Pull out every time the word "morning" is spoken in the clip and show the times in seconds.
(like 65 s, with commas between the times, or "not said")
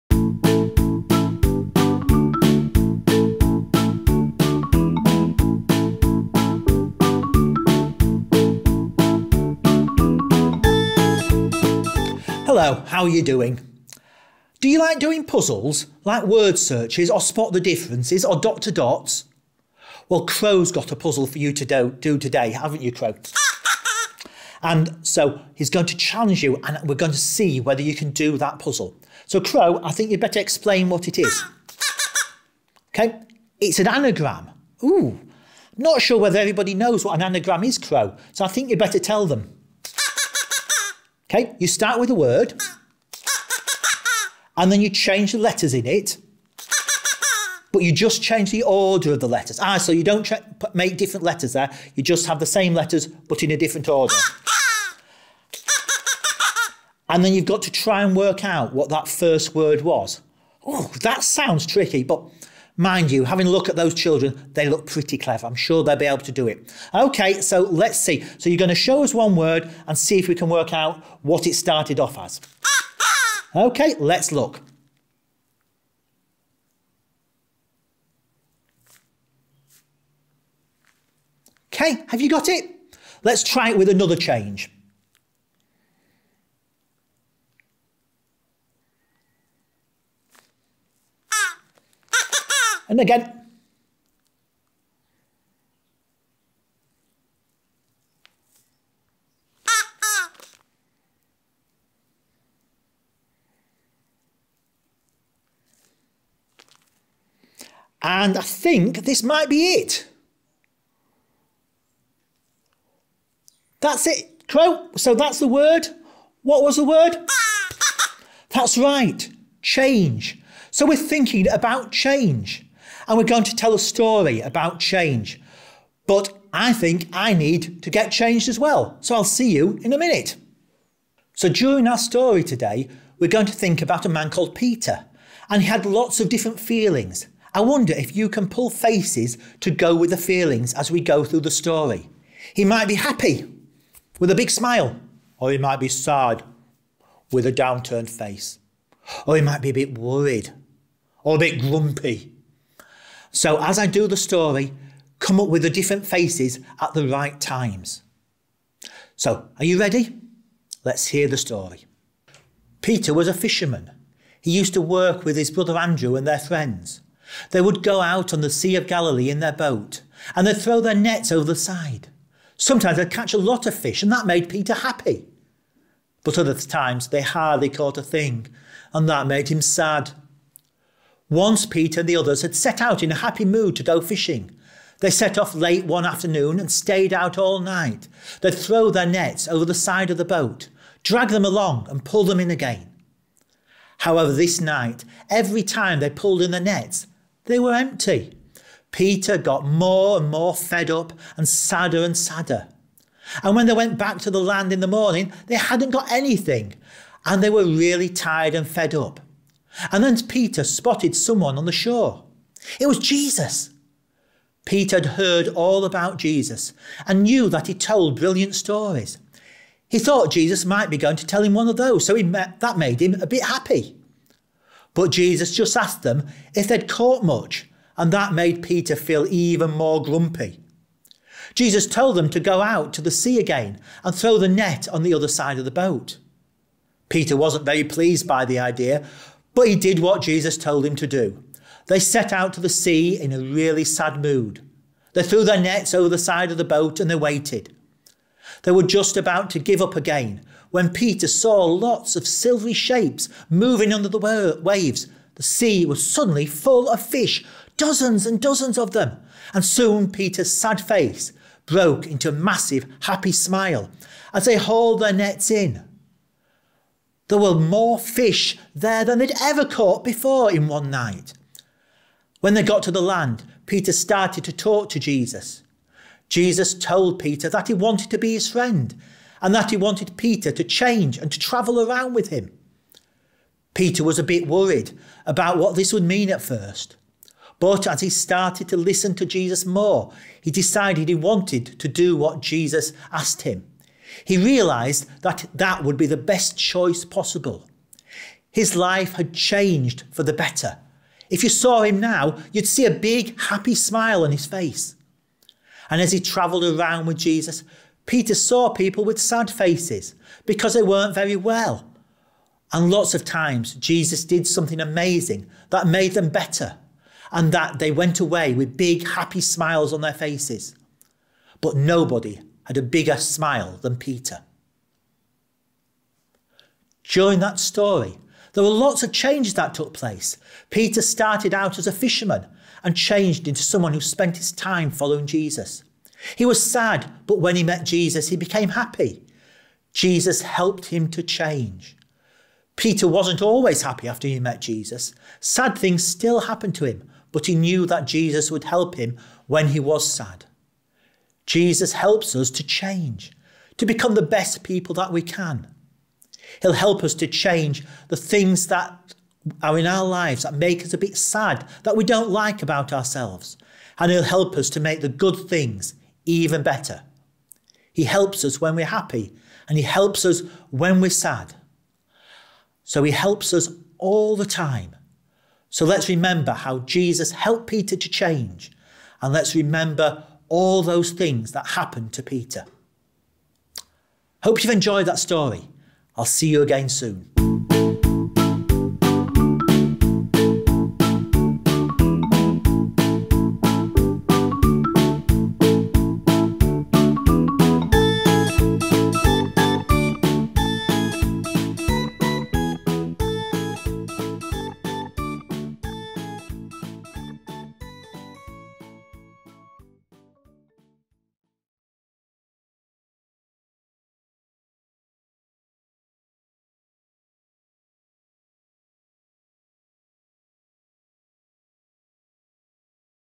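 204 s.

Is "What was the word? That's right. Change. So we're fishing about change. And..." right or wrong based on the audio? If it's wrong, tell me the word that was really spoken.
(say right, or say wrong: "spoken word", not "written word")
wrong: "thinking", not "fishing".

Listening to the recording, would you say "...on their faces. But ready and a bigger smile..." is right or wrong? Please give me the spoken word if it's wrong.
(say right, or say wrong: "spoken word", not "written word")
wrong: "nobody", not "ready".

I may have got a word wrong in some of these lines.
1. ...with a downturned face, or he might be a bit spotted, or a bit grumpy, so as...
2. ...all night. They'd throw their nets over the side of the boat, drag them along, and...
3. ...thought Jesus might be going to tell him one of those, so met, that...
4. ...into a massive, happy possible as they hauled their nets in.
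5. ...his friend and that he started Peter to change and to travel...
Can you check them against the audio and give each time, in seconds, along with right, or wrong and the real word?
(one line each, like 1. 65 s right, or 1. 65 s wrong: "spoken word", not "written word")
1. 147 s wrong: "worried", not "spotted"
2. 187 s right
3. 219 s right
4. 262 s wrong: "smile", not "possible"
5. 278 s wrong: "wanted", not "started".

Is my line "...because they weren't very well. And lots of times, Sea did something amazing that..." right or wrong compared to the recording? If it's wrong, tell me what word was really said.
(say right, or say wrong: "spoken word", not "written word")
wrong: "Jesus", not "Sea".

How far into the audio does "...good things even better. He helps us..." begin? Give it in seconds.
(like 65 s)
365 s.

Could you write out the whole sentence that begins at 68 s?
So you're going to show us one word and see if we can work out what it started off as.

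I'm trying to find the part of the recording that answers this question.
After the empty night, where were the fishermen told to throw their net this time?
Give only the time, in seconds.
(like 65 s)
235 s.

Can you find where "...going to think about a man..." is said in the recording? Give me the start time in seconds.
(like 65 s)
133 s.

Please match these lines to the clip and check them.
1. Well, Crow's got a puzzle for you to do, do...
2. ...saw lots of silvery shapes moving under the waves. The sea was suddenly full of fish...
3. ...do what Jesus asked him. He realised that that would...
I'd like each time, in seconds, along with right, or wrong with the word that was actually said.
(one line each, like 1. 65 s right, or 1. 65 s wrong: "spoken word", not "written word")
1. 20 s right
2. 251 s right
3. 291 s right.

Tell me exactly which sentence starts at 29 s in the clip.
So, Crow, I think you'd better explain what it is.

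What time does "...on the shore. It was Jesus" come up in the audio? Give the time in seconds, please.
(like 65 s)
211 s.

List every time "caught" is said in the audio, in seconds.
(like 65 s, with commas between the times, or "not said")
177 s, 226 s, 269 s.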